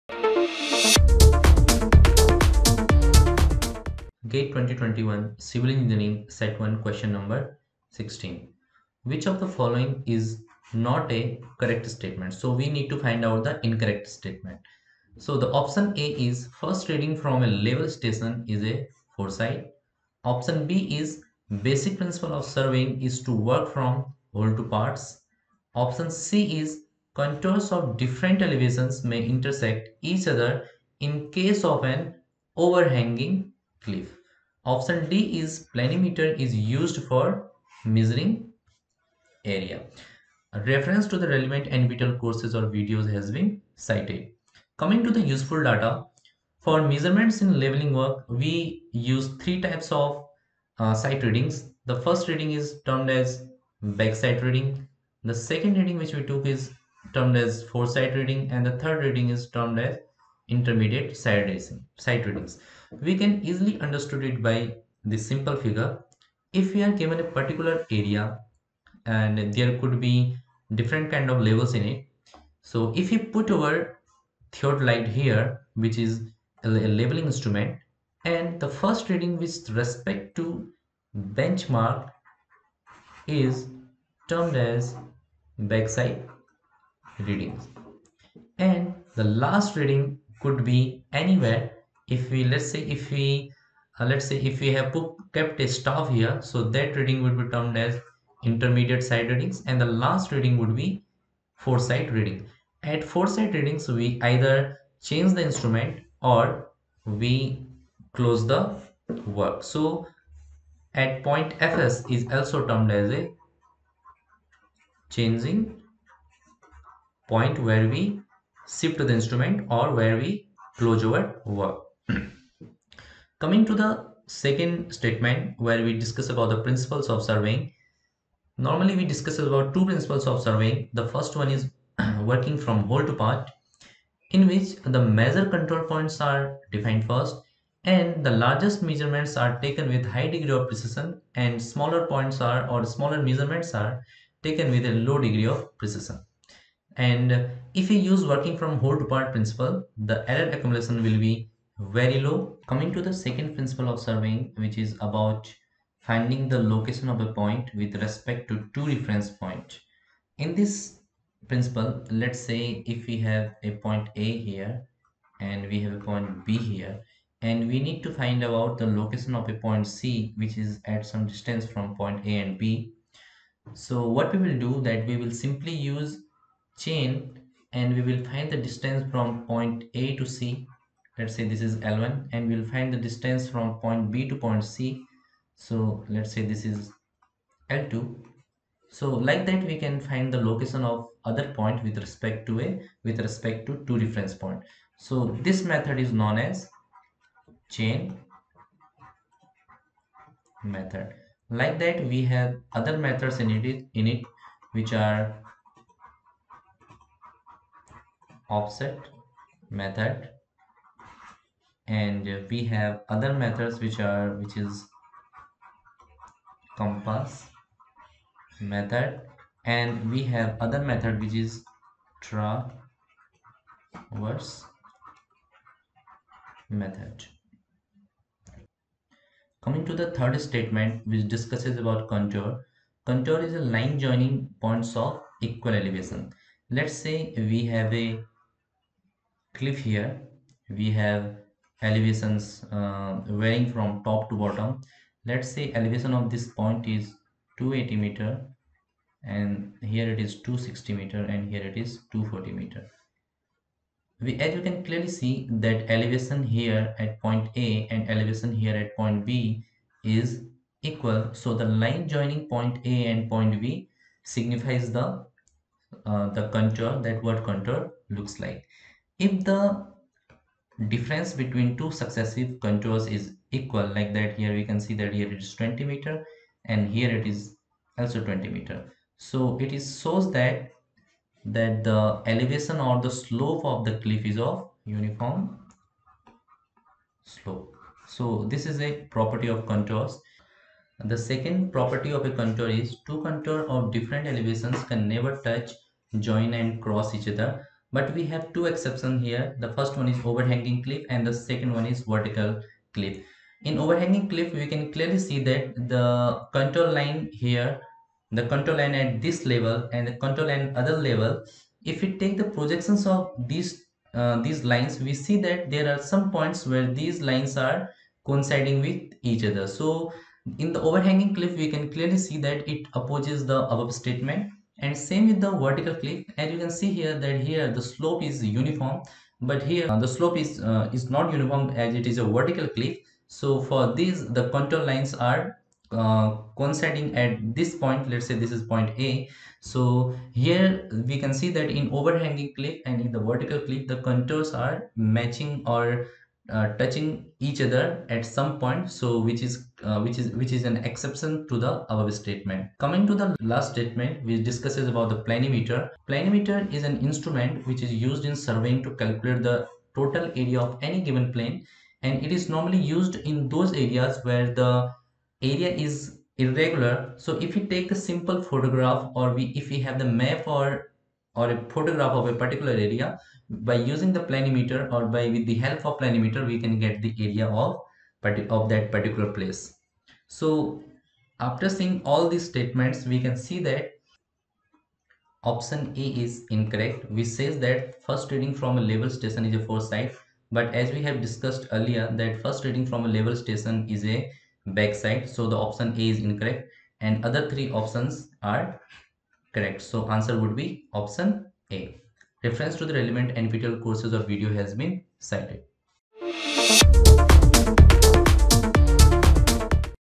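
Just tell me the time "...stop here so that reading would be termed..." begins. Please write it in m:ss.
1:35.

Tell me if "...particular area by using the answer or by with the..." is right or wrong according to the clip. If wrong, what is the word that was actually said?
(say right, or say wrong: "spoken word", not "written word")
wrong: "planimeter", not "answer".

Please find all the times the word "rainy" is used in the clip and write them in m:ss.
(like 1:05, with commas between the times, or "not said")
not said.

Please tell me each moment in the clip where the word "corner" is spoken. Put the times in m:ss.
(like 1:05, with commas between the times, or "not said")
not said.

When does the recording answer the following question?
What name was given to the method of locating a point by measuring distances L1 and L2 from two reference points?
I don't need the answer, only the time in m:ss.
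3:17.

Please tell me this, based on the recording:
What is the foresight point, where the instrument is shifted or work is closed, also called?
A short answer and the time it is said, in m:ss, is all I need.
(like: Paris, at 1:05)
changing point, at 1:55.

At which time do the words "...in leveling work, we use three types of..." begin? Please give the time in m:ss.
0:47.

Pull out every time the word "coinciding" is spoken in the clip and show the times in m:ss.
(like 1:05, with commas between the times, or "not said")
5:18, 5:36.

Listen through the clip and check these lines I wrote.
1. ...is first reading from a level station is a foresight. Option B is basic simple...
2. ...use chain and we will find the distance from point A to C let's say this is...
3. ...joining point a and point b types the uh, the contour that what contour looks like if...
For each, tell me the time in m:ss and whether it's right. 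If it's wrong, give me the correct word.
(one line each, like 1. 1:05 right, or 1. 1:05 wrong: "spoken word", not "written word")
1. 0:16 wrong: "principle", not "simple"
2. 2:55 right
3. 4:22 wrong: "signifies", not "types".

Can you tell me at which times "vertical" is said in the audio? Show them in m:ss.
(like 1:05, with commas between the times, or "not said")
5:02, 5:25, 5:32, 5:43.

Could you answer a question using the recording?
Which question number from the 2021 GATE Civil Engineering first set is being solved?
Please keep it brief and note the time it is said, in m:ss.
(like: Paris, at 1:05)
16, at 0:06.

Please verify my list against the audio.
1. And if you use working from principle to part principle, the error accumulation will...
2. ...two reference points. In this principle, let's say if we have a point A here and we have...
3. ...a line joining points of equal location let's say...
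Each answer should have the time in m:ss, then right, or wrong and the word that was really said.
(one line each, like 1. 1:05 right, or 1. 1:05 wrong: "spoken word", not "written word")
1. 2:26 wrong: "whole", not "principle"
2. 2:38 right
3. 3:53 wrong: "elevation", not "location".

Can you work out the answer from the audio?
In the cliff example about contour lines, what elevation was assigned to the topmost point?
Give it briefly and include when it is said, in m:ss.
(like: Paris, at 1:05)
280 meter, at 4:07.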